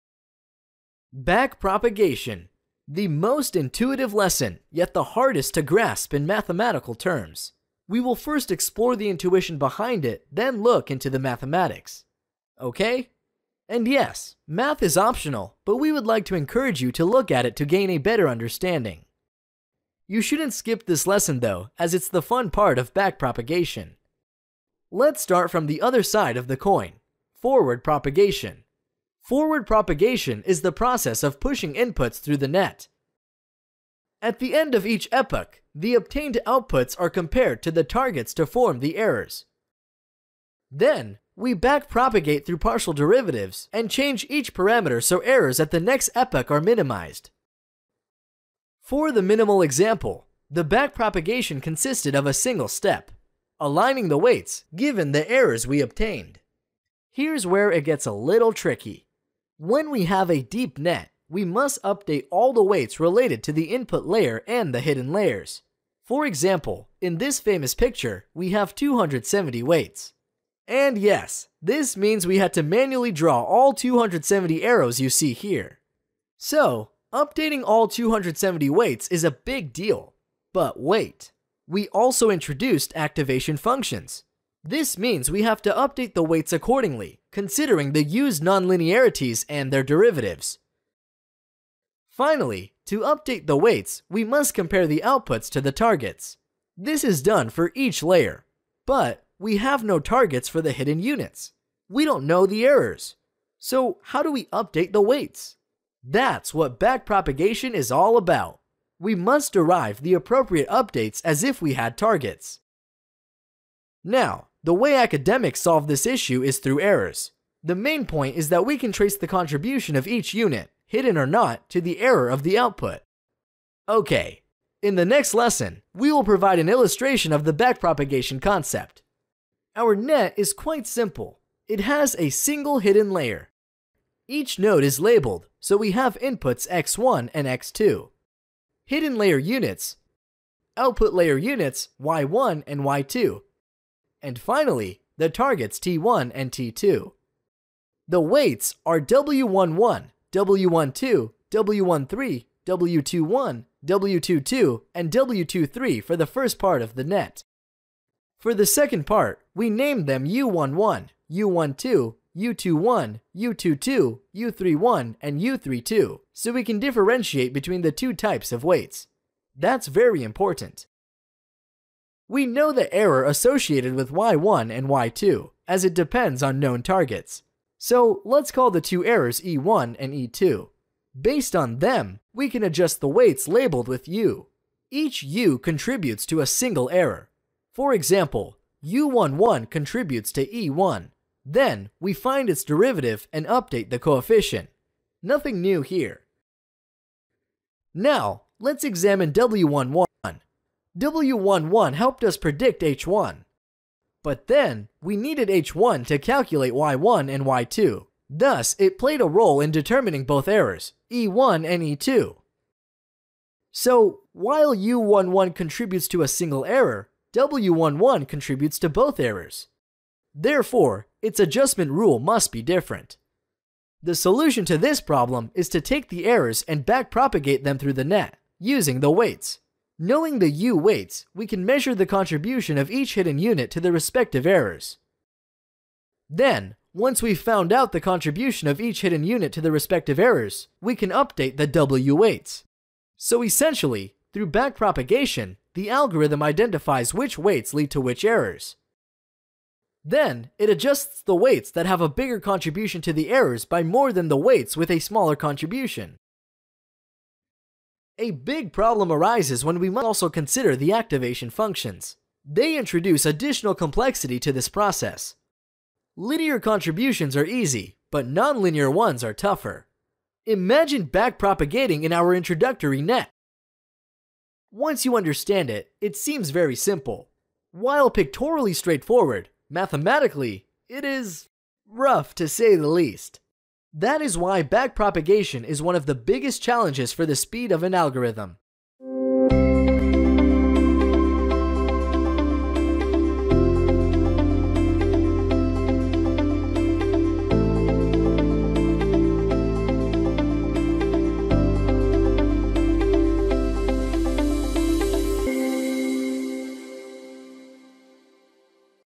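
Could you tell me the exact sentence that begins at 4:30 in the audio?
Imagine backpropagating in our introductory net.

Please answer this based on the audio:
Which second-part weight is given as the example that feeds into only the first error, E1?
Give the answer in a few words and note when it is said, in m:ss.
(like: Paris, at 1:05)
U11, at 3:08.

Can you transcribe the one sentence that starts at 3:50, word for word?
Knowing the U weights, we can measure the contribution of each hidden unit to the respective errors.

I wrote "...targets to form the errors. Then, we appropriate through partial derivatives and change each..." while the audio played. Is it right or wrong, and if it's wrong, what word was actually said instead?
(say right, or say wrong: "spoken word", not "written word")
wrong: "backpropagate", not "appropriate".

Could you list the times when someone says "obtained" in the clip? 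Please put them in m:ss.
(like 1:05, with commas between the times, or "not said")
0:35, 0:55.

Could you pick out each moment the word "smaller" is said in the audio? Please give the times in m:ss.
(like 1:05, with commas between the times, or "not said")
4:14.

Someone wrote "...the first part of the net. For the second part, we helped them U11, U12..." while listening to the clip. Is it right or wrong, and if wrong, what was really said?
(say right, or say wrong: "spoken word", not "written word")
wrong: "named", not "helped".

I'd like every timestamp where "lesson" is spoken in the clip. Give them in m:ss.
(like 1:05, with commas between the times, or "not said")
0:04, 0:21, 2:05.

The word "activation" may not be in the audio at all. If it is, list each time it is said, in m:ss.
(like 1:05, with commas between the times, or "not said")
1:22, 4:20.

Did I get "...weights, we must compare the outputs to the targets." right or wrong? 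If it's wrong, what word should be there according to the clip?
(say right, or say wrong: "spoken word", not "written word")
right.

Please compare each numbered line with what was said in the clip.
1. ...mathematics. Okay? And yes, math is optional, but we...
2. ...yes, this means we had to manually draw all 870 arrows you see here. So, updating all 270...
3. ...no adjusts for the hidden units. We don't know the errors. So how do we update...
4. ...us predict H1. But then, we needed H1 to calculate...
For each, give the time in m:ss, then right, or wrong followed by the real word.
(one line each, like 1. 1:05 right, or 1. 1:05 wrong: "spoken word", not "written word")
1. 0:11 right
2. 1:10 wrong: "270", not "870"
3. 1:39 wrong: "targets", not "adjusts"
4. 3:22 right.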